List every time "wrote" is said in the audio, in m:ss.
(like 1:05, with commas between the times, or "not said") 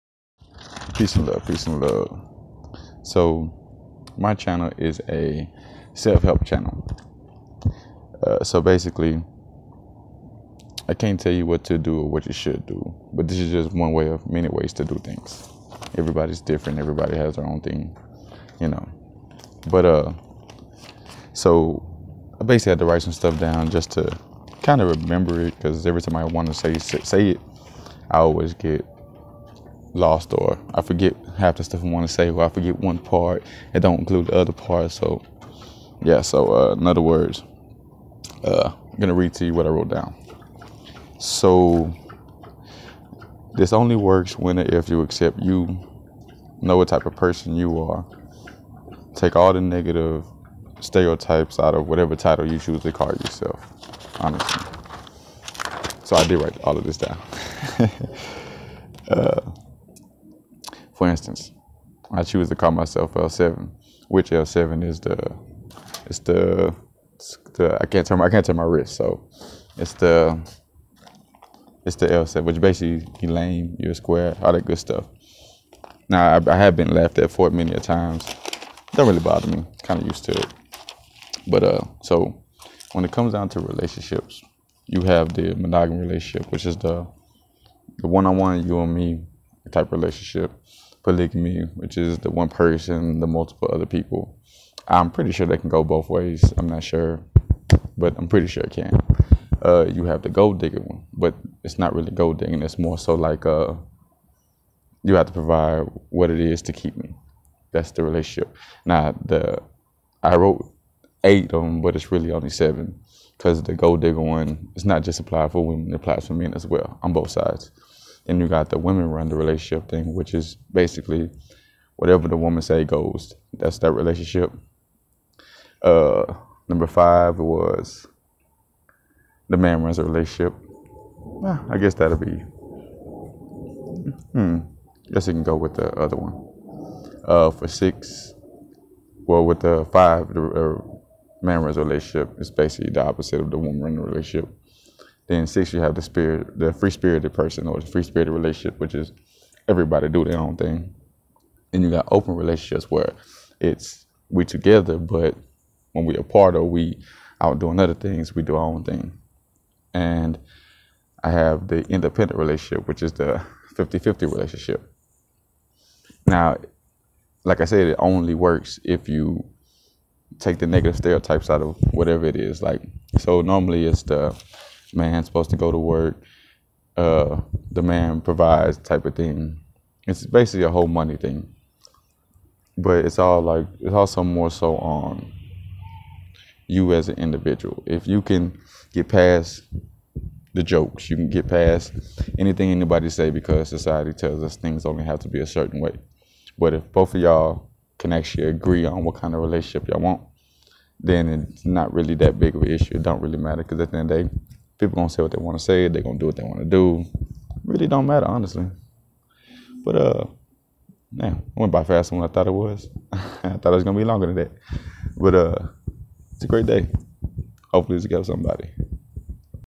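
0:39, 1:50.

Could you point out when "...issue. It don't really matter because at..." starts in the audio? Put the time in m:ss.
3:22.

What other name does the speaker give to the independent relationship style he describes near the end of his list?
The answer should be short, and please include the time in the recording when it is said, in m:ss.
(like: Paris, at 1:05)
50-50 relationship, at 2:43.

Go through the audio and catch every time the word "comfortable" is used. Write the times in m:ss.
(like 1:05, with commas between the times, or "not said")
not said.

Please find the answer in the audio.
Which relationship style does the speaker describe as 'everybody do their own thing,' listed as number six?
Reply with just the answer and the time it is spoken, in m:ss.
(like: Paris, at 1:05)
free spirited relationship, at 2:27.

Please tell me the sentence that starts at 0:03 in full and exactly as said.
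So, my channel is a self help channel.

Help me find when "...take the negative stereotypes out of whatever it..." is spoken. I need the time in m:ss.
2:50.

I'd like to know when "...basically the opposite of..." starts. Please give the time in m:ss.
2:22.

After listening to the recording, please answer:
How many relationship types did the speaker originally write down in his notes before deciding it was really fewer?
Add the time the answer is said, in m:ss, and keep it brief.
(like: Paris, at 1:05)
8, at 1:51.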